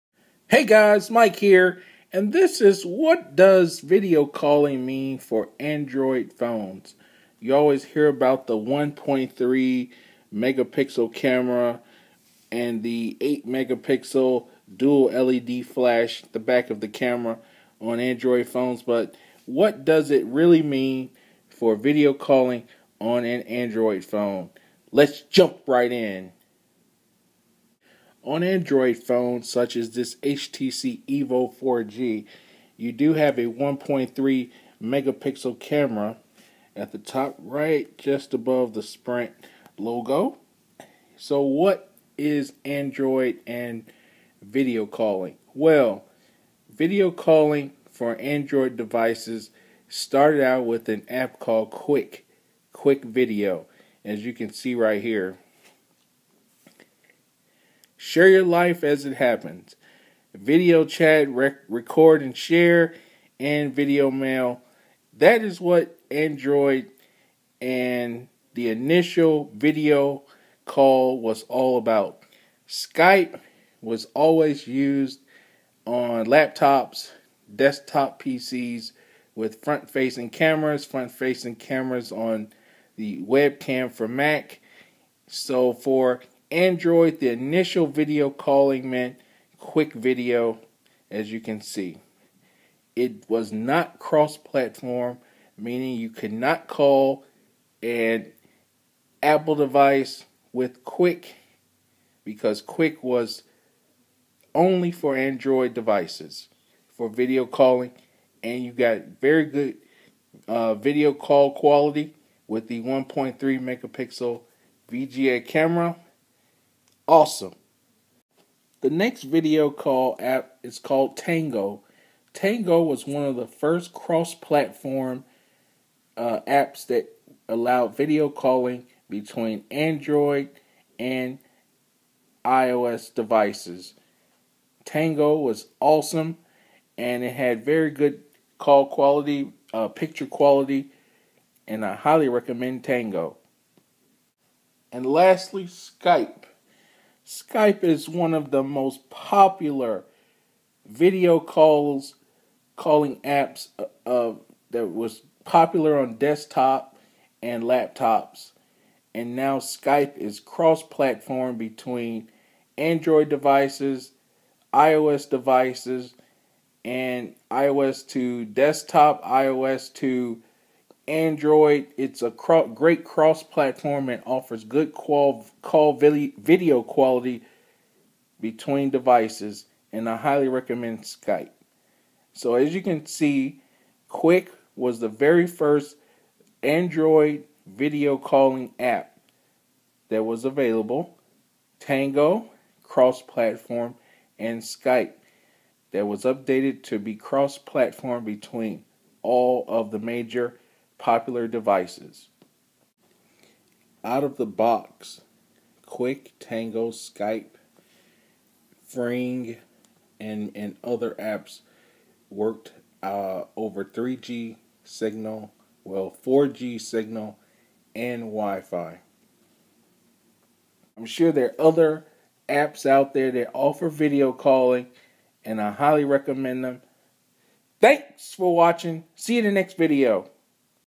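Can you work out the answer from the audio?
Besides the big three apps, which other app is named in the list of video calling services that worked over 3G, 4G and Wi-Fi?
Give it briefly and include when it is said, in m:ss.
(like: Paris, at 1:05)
Fring, at 3:28.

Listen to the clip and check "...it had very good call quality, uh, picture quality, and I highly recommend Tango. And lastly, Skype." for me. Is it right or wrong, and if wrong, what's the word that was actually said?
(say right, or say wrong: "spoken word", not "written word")
right.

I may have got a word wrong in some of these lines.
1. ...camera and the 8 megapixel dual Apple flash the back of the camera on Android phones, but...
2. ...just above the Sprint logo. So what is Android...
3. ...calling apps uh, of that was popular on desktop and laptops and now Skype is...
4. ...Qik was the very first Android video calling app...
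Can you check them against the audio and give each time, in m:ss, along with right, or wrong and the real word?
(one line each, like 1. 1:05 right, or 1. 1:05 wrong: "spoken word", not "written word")
1. 0:11 wrong: "LED", not "Apple"
2. 0:37 right
3. 2:32 right
4. 3:04 right.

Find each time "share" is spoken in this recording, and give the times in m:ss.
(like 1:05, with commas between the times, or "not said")
0:58, 1:02.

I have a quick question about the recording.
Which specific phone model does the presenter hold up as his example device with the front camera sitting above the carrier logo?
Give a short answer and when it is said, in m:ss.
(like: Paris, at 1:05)
HTC Evo 4G, at 0:30.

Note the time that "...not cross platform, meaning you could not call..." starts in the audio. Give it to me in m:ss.
1:33.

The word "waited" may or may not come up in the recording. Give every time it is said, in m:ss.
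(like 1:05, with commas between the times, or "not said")
not said.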